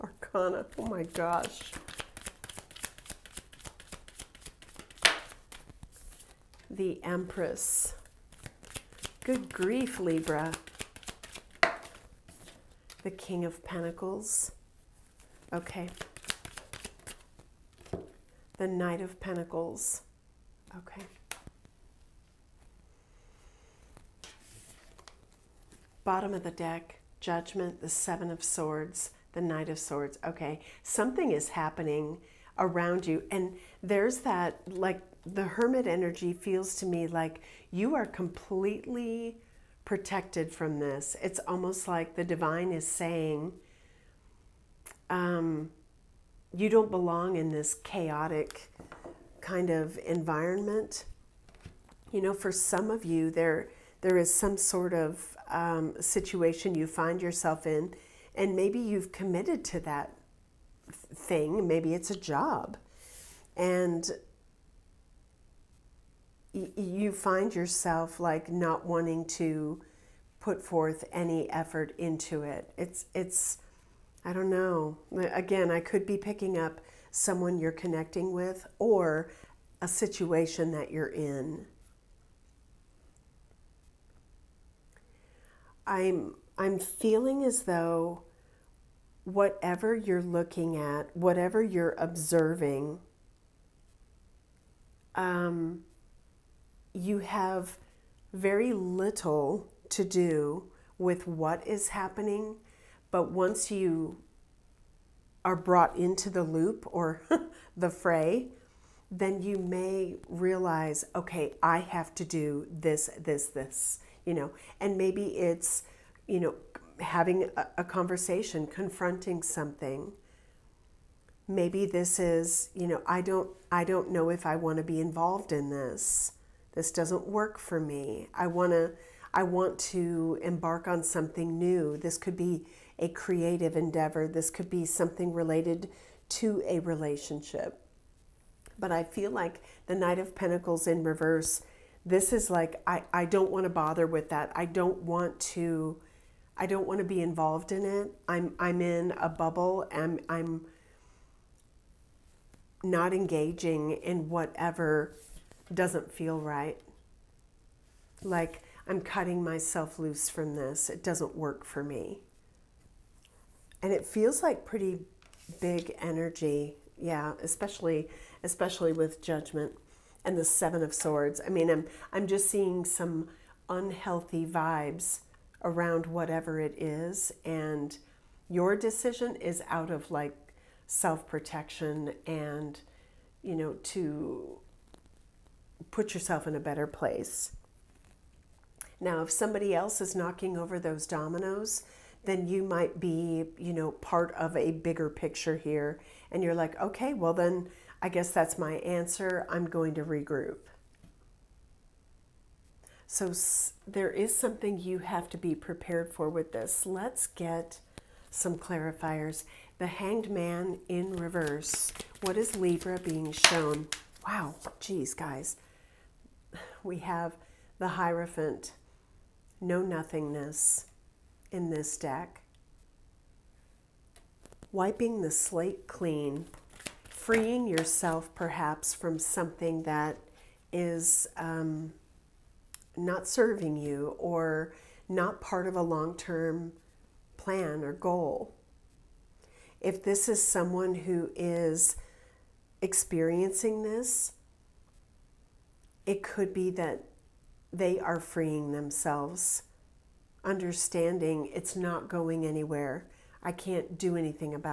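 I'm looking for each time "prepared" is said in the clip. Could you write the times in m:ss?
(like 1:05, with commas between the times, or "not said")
3:25.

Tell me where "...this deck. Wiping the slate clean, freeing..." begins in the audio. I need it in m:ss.
3:41.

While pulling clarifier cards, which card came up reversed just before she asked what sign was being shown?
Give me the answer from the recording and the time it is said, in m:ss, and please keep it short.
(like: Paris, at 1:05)
The Hanged Man, at 3:29.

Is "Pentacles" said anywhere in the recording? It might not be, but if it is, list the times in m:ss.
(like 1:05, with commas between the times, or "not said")
0:13, 0:19, 2:20.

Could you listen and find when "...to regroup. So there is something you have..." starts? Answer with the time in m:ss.
3:19.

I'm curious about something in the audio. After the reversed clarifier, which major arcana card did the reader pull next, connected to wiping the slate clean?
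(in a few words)
The Hierophant.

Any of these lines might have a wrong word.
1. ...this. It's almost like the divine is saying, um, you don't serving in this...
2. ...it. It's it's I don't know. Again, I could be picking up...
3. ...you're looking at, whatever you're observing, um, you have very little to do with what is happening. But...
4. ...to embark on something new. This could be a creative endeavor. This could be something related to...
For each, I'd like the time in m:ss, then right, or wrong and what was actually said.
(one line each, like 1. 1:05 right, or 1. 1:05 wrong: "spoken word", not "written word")
1. 0:40 wrong: "belong", not "serving"
2. 1:12 right
3. 1:29 right
4. 2:09 right.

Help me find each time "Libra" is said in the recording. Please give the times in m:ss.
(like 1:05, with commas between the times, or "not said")
0:09, 3:32.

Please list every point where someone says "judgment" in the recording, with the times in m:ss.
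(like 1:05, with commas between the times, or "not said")
0:27, 2:49.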